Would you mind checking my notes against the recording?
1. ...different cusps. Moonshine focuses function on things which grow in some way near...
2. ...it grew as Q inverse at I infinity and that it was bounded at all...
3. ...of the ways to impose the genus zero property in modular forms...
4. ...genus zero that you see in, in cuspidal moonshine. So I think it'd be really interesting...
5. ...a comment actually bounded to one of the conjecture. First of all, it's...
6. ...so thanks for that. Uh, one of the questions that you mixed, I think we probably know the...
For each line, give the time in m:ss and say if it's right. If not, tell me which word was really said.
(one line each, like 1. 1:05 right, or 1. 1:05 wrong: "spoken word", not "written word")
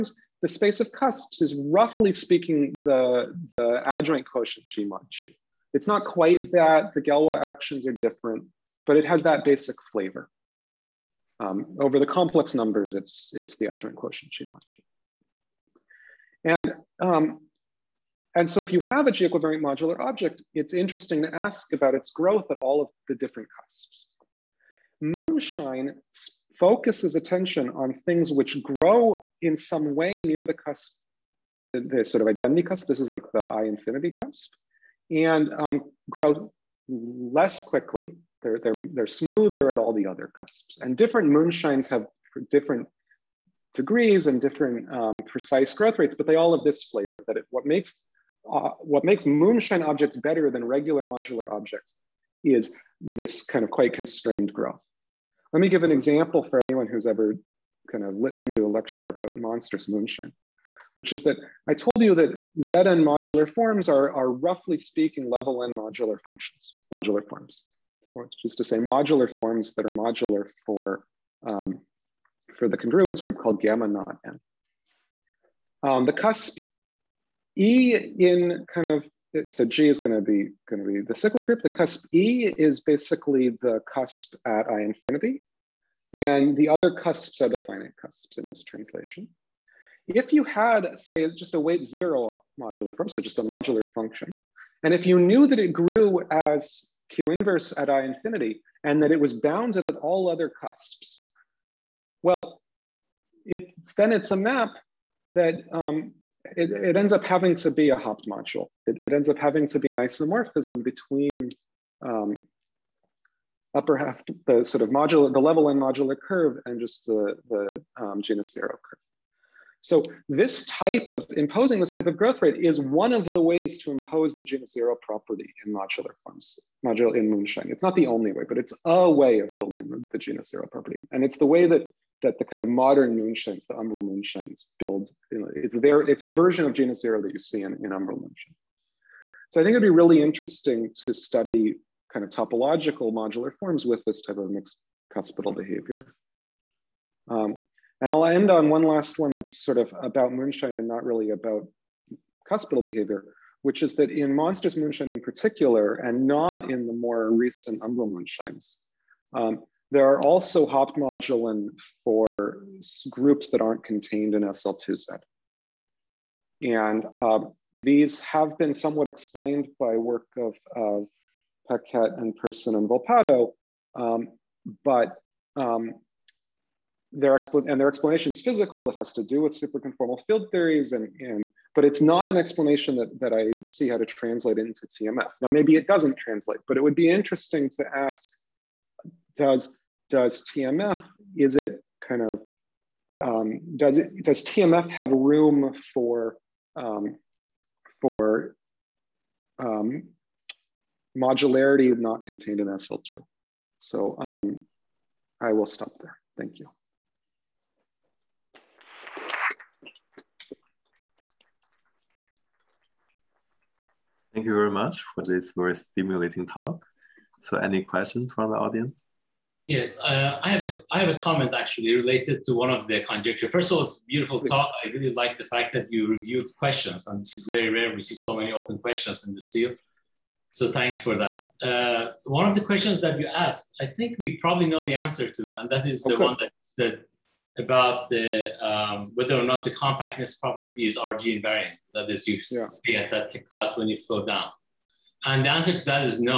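1. 0:23 wrong: "attention", not "function"
2. 1:35 right
3. 2:03 right
4. 2:16 wrong: "umbral", not "cuspidal"
5. 3:41 wrong: "related", not "bounded"
6. 3:50 wrong: "asked", not "mixed".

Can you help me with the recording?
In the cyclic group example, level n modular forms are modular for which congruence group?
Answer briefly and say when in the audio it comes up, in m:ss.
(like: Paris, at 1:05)
gamma naught n, at 1:13.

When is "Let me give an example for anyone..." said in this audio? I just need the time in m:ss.
0:55.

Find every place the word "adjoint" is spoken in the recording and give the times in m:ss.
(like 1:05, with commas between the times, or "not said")
0:03, 0:13.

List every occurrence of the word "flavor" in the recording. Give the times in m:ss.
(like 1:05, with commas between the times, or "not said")
0:09, 0:46.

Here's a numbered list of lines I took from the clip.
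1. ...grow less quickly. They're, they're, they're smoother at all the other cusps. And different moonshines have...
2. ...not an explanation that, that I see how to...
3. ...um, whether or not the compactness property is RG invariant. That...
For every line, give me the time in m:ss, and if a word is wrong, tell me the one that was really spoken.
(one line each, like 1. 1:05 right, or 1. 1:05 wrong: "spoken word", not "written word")
1. 0:36 right
2. 3:02 right
3. 3:58 right.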